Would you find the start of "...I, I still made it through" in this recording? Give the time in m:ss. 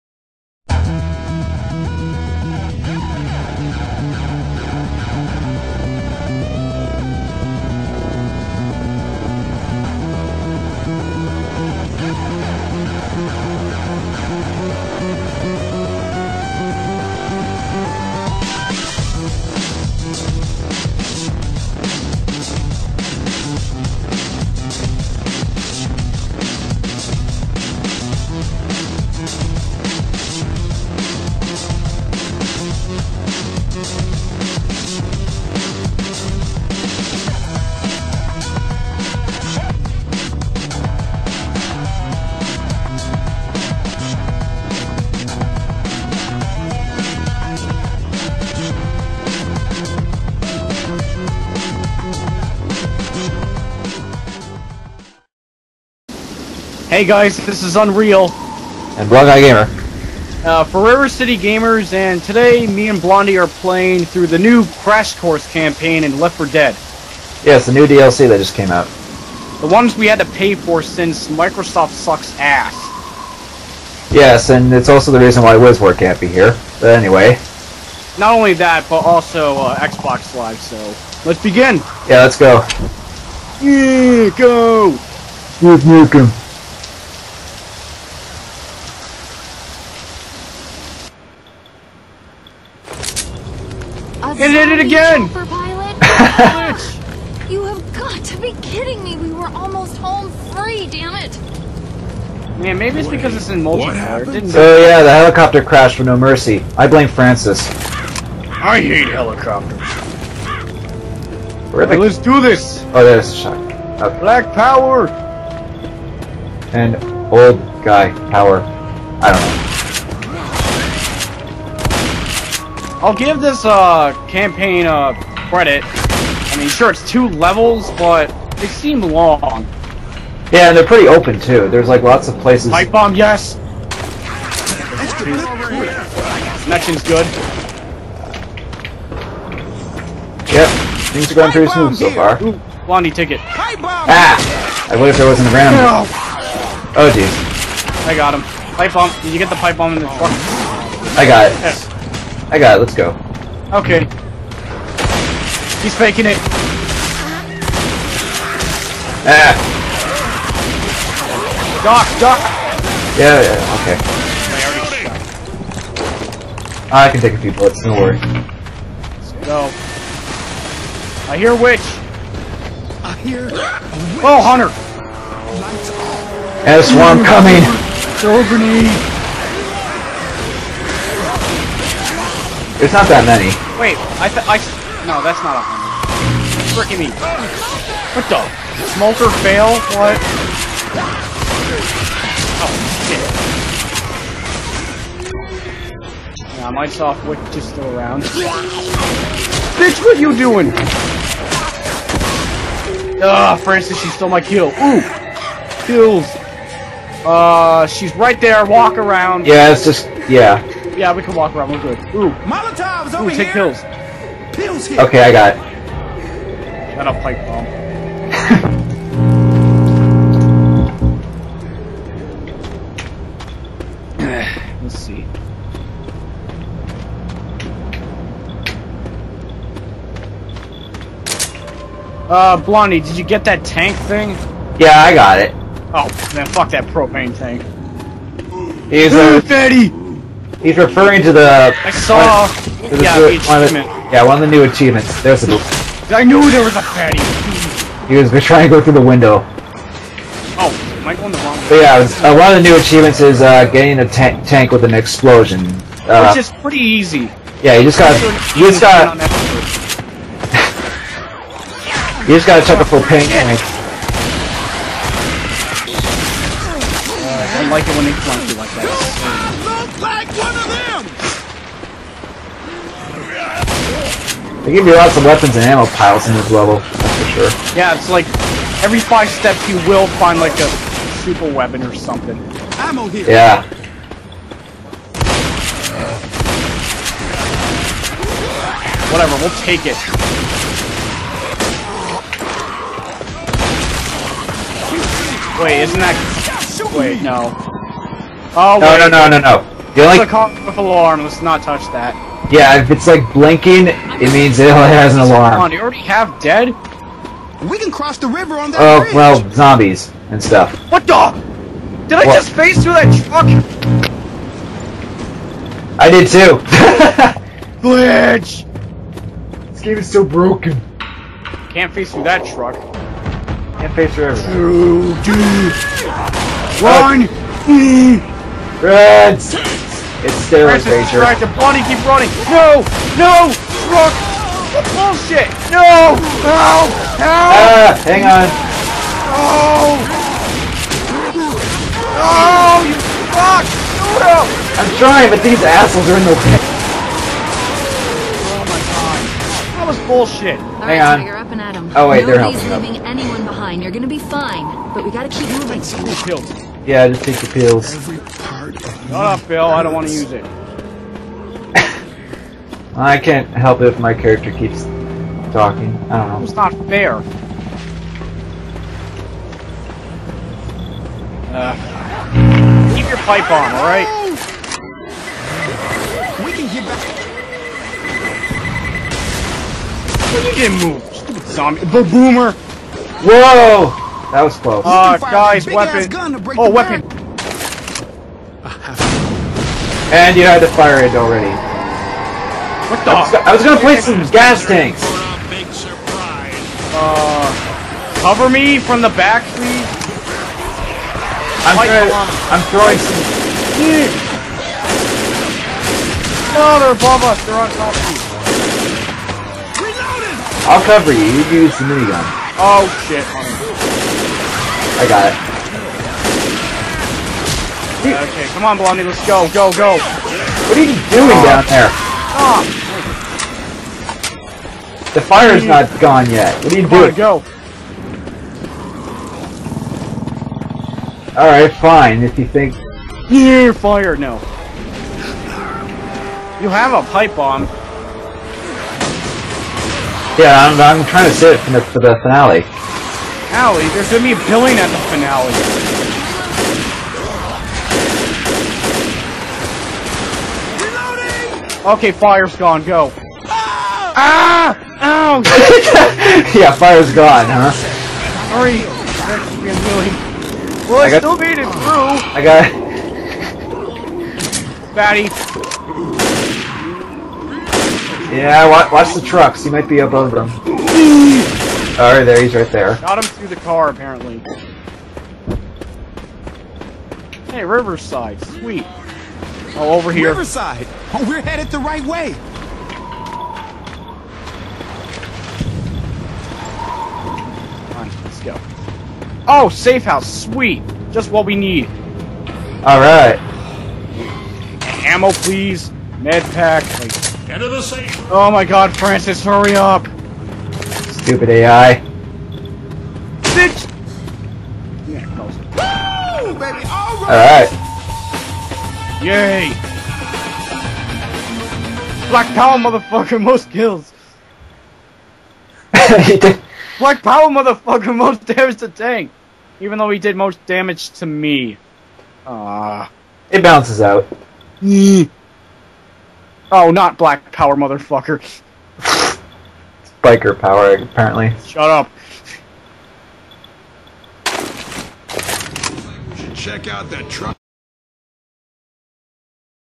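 7:41.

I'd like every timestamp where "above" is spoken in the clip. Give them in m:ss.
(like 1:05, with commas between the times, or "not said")
6:46, 7:49.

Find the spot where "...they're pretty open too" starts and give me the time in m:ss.
2:10.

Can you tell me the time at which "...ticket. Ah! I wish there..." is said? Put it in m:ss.
2:23.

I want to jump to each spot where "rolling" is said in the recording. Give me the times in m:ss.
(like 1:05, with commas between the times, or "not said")
not said.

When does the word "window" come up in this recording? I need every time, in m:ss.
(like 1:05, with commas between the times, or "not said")
4:09.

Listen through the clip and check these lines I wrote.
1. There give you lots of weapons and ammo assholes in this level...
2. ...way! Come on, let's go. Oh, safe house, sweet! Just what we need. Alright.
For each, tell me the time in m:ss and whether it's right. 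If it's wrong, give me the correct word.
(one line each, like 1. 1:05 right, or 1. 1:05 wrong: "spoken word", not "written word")
1. 4:34 wrong: "piles", not "assholes"
2. 8:02 right.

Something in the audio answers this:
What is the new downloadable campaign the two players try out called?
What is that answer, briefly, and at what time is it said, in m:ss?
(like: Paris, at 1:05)
Crash Course, at 1:04.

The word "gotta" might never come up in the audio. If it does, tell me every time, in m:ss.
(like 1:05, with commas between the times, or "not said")
4:22, 5:55.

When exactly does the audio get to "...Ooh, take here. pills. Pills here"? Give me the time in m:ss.
3:33.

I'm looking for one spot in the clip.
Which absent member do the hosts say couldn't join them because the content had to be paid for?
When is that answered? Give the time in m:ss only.
1:15.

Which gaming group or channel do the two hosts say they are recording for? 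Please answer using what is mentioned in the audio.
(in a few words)
River City Gamers.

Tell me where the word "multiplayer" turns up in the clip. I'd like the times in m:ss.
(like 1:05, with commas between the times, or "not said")
1:43.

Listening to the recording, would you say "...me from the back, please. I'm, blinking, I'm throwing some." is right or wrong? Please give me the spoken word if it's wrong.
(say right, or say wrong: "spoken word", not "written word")
wrong: "trying", not "blinking".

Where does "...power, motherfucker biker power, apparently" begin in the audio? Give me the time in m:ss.
8:47.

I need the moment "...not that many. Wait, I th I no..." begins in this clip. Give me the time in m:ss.
3:02.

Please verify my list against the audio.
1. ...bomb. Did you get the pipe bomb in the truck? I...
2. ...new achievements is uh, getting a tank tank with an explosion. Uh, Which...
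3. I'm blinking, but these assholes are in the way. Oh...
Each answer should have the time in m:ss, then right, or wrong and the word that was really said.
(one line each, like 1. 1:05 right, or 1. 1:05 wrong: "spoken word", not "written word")
1. 2:28 right
2. 4:12 right
3. 5:44 wrong: "trying", not "blinking".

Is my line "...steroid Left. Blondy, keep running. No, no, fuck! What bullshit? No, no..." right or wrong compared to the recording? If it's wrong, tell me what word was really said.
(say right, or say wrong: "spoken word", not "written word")
wrong: "Racer", not "Left".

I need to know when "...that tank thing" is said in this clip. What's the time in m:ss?
3:53.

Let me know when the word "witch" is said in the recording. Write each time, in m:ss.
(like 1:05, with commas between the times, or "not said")
2:51, 3:17.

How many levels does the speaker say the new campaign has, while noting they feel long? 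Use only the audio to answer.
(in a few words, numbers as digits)
2.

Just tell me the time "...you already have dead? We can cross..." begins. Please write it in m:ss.
5:05.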